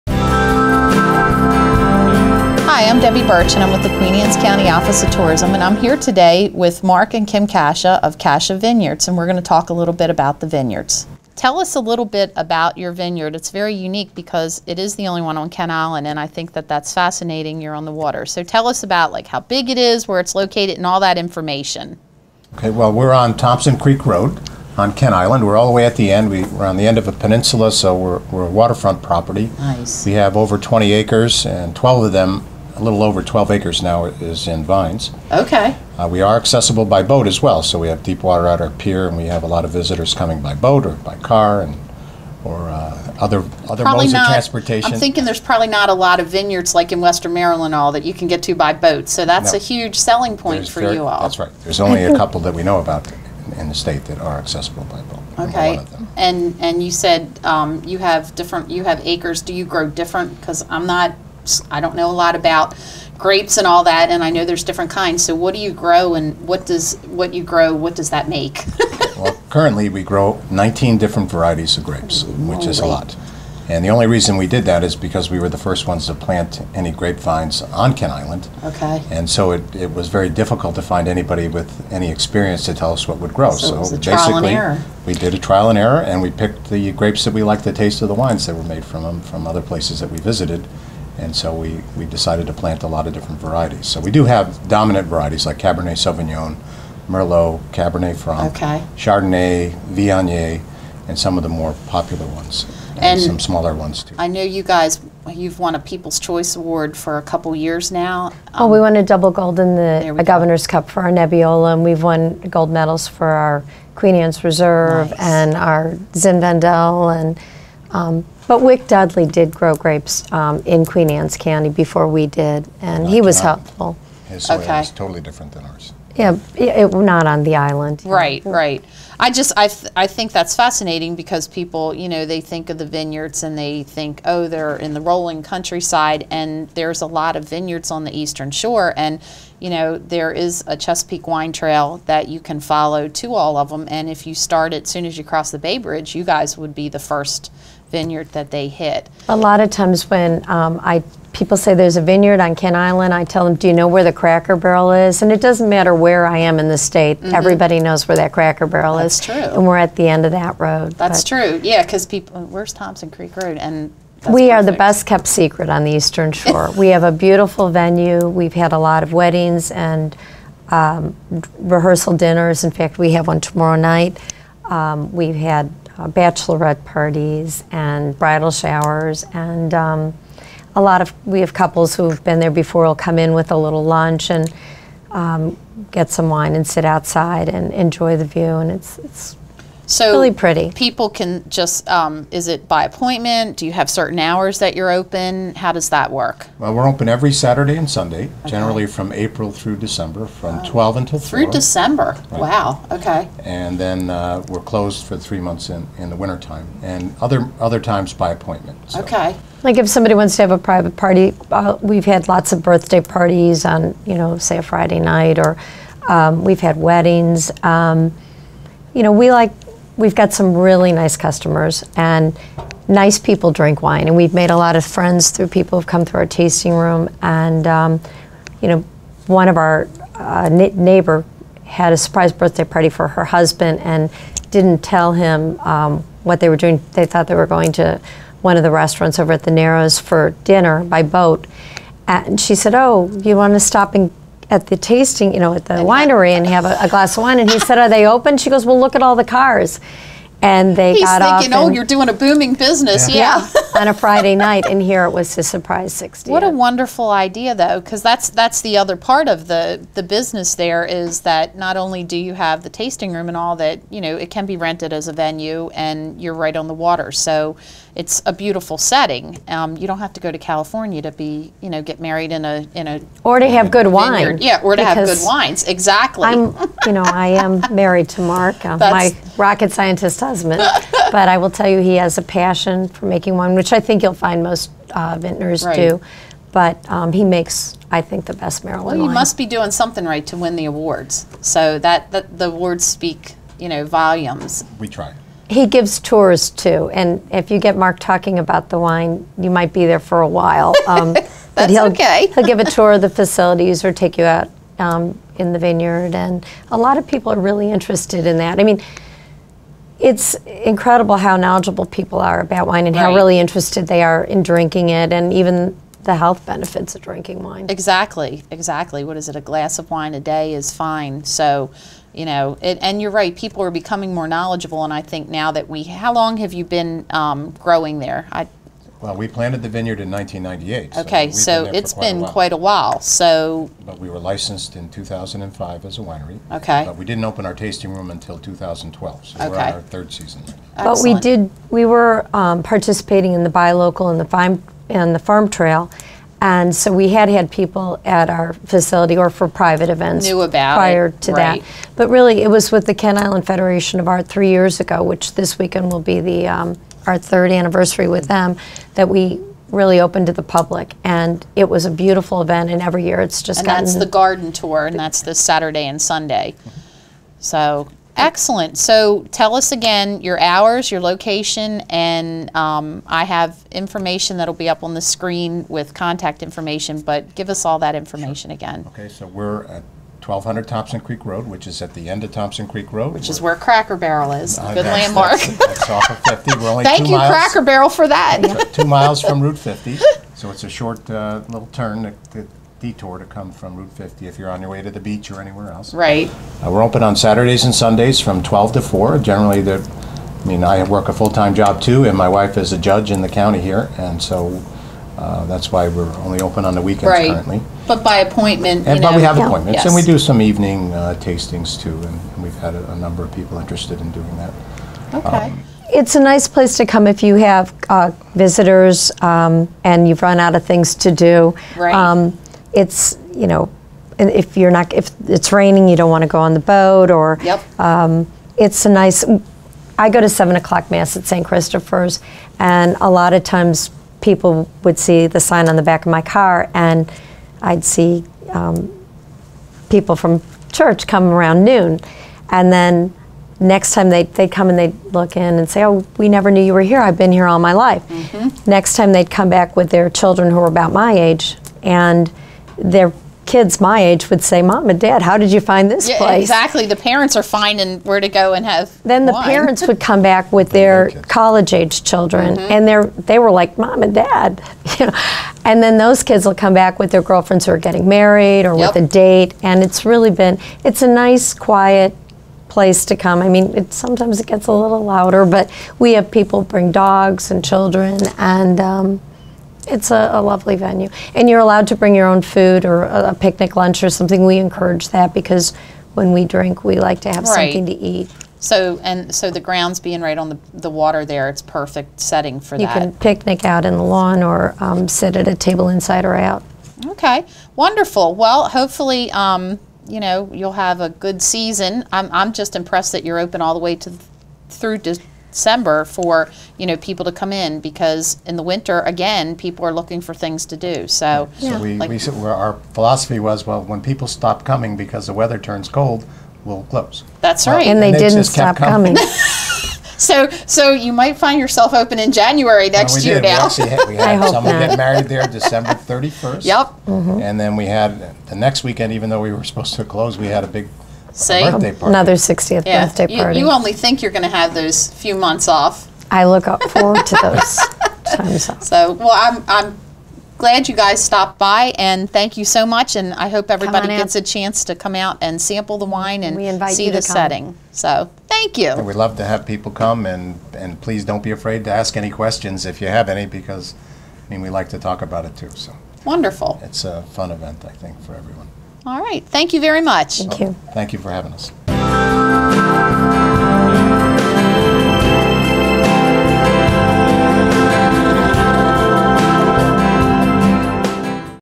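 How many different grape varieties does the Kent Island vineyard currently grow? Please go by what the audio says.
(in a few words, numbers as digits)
19.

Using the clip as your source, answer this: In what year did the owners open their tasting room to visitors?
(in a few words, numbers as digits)
2012.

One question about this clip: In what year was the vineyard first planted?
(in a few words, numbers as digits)
1998.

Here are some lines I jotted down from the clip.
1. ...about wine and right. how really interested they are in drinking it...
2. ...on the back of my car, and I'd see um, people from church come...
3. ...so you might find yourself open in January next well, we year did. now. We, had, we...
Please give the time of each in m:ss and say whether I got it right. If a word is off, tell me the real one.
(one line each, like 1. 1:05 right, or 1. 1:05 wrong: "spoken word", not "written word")
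1. 5:12 right
2. 7:15 right
3. 8:40 right.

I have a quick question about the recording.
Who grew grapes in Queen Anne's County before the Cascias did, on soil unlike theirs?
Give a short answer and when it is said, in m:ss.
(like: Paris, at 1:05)
Wick Dudley, at 1:58.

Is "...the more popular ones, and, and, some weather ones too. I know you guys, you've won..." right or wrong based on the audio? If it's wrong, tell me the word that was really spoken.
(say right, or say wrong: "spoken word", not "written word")
wrong: "smaller", not "weather".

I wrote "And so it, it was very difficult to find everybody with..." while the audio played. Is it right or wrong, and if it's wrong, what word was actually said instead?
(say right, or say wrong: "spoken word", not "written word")
wrong: "anybody", not "everybody".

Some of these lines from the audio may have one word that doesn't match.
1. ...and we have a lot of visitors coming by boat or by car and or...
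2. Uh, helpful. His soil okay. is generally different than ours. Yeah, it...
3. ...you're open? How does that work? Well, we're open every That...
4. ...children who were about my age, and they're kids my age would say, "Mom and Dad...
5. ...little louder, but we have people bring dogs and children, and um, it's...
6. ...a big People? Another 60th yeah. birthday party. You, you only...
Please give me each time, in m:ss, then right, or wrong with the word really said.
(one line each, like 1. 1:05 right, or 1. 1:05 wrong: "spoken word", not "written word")
1. 0:39 right
2. 2:03 wrong: "totally", not "generally"
3. 3:14 wrong: "Saturday", not "That"
4. 7:30 right
5. 7:54 right
6. 8:50 wrong: "See", not "People".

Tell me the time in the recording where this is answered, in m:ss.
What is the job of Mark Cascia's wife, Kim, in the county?
6:42.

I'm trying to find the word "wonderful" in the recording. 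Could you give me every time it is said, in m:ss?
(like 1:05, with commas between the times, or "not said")
4:16, 8:17, 9:16.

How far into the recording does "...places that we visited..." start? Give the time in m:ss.
1:29.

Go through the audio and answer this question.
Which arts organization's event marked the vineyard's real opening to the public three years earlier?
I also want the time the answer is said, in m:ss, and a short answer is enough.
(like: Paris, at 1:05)
Kent Island Federation of Art, at 5:52.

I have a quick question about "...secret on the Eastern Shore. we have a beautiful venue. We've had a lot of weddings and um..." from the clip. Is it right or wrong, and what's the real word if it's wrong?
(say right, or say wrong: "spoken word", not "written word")
right.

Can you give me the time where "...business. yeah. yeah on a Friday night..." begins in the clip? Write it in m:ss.
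4:12.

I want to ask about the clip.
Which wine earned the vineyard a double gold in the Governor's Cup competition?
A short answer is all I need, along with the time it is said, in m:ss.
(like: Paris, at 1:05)
Nebbiolo, at 1:51.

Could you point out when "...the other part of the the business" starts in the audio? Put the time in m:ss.
4:18.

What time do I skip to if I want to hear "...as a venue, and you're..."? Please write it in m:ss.
4:24.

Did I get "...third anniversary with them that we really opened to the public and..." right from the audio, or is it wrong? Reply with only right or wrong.
right.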